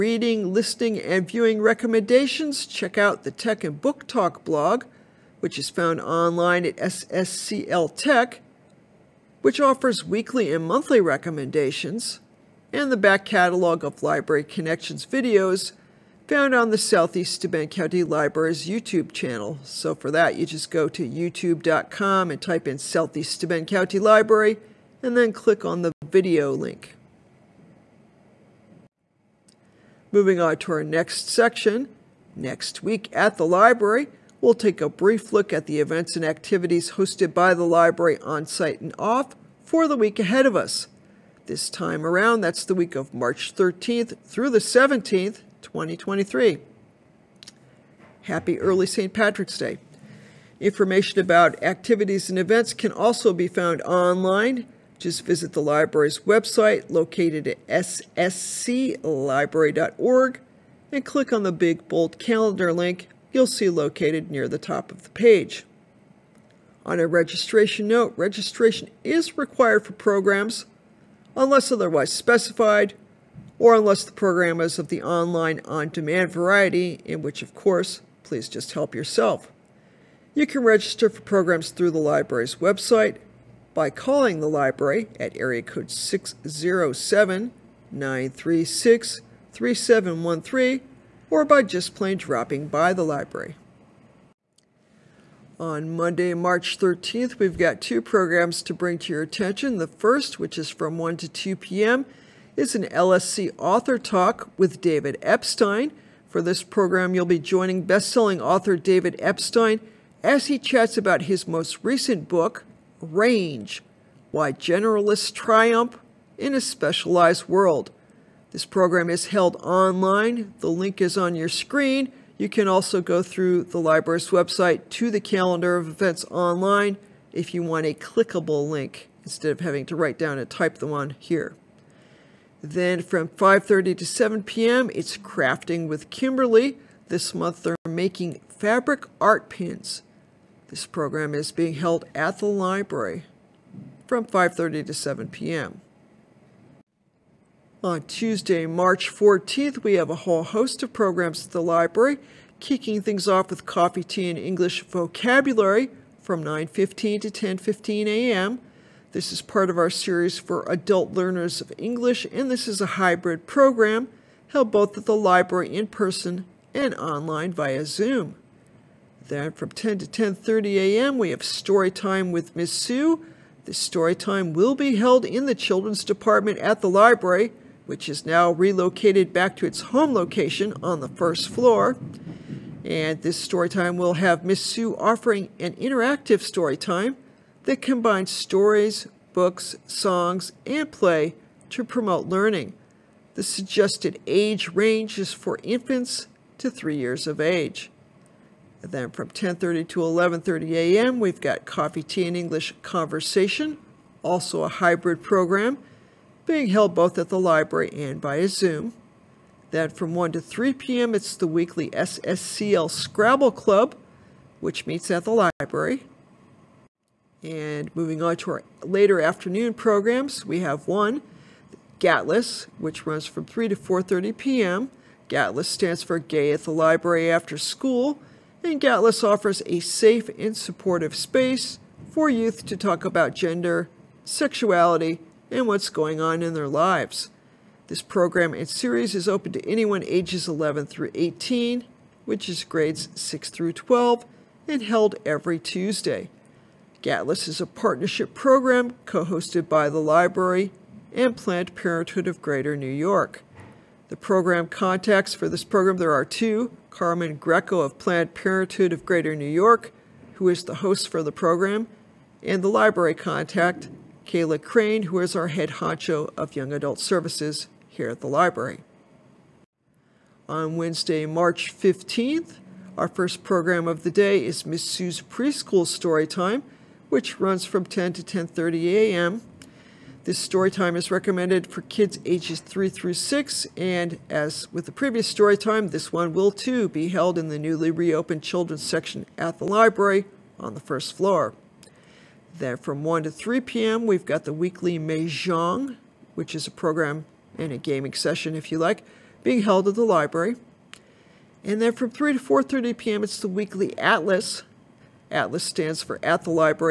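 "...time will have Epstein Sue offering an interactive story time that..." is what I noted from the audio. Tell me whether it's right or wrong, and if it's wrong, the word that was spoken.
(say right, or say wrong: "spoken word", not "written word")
wrong: "Miss", not "Epstein".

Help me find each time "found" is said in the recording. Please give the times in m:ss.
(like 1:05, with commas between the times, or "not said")
0:05, 0:16, 0:53.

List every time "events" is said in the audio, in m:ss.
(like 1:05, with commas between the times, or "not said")
0:35, 0:52, 2:05.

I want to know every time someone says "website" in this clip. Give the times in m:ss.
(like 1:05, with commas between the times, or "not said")
0:56, 1:22, 2:04.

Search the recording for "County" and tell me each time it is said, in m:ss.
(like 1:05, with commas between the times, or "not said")
0:17, 0:23.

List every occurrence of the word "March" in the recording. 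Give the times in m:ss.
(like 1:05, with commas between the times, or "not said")
0:43, 1:36, 2:28, 4:31.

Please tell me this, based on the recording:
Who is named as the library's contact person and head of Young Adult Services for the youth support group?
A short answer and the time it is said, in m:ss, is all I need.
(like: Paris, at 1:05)
Kayla Crane, at 4:24.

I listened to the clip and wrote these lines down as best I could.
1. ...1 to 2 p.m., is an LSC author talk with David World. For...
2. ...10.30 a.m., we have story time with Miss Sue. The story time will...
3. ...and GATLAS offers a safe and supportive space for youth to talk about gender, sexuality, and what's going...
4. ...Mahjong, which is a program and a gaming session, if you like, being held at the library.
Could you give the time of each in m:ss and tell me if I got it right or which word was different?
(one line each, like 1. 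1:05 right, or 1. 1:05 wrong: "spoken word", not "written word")
1. 1:40 wrong: "Epstein", not "World"
2. 2:50 right
3. 3:48 right
4. 4:54 right.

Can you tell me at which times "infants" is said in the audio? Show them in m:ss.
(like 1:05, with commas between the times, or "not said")
3:15.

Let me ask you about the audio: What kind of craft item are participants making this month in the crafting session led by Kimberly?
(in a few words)
Fabric art pins.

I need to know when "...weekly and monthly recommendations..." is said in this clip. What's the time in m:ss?
0:10.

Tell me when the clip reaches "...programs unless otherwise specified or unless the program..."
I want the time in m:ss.
1:09.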